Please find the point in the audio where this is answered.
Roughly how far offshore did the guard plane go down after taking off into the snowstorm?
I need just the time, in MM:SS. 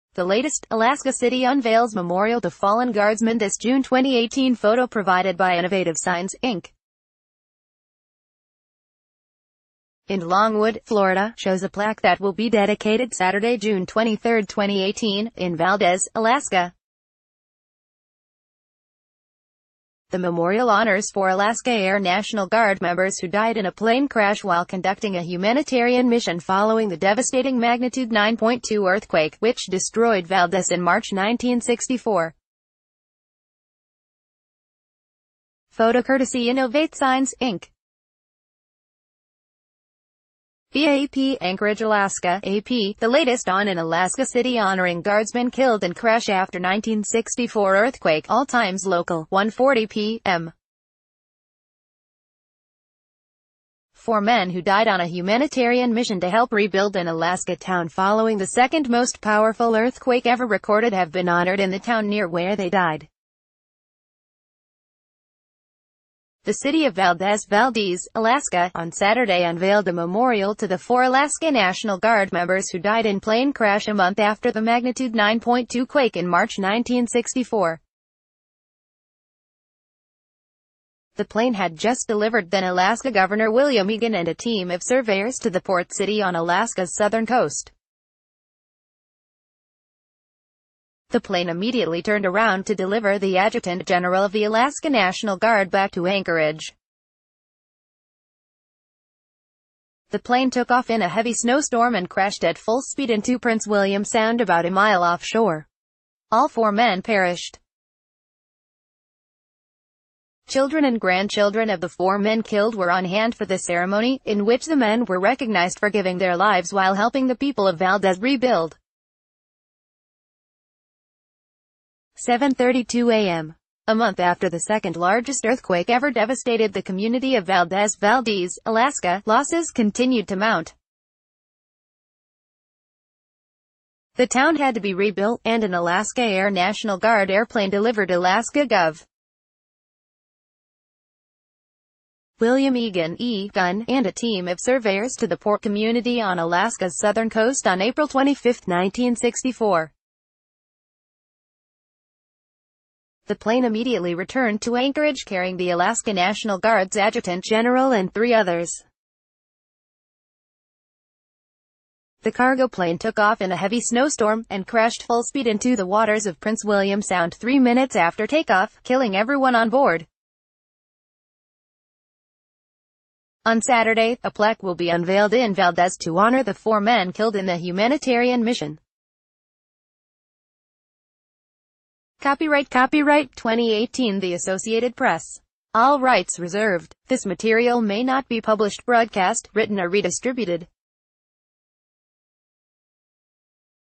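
01:44.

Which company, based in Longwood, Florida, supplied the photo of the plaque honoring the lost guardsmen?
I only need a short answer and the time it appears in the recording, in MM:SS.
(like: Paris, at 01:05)
Innovative Signs, Inc., at 00:05.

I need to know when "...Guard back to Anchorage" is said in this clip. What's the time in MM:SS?
01:35.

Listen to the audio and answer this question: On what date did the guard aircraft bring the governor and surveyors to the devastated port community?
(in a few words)
April 25, 1964.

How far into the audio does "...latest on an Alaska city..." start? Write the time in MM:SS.
00:43.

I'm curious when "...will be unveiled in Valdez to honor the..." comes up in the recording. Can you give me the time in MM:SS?
02:54.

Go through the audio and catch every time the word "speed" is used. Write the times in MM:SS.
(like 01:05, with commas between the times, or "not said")
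01:42, 02:45.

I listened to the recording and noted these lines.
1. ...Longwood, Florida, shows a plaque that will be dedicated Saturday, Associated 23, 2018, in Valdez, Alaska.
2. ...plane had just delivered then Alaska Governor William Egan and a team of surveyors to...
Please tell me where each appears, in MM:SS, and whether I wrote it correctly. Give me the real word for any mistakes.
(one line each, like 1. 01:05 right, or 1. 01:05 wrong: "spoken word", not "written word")
1. 00:10 wrong: "June", not "Associated"
2. 01:21 right.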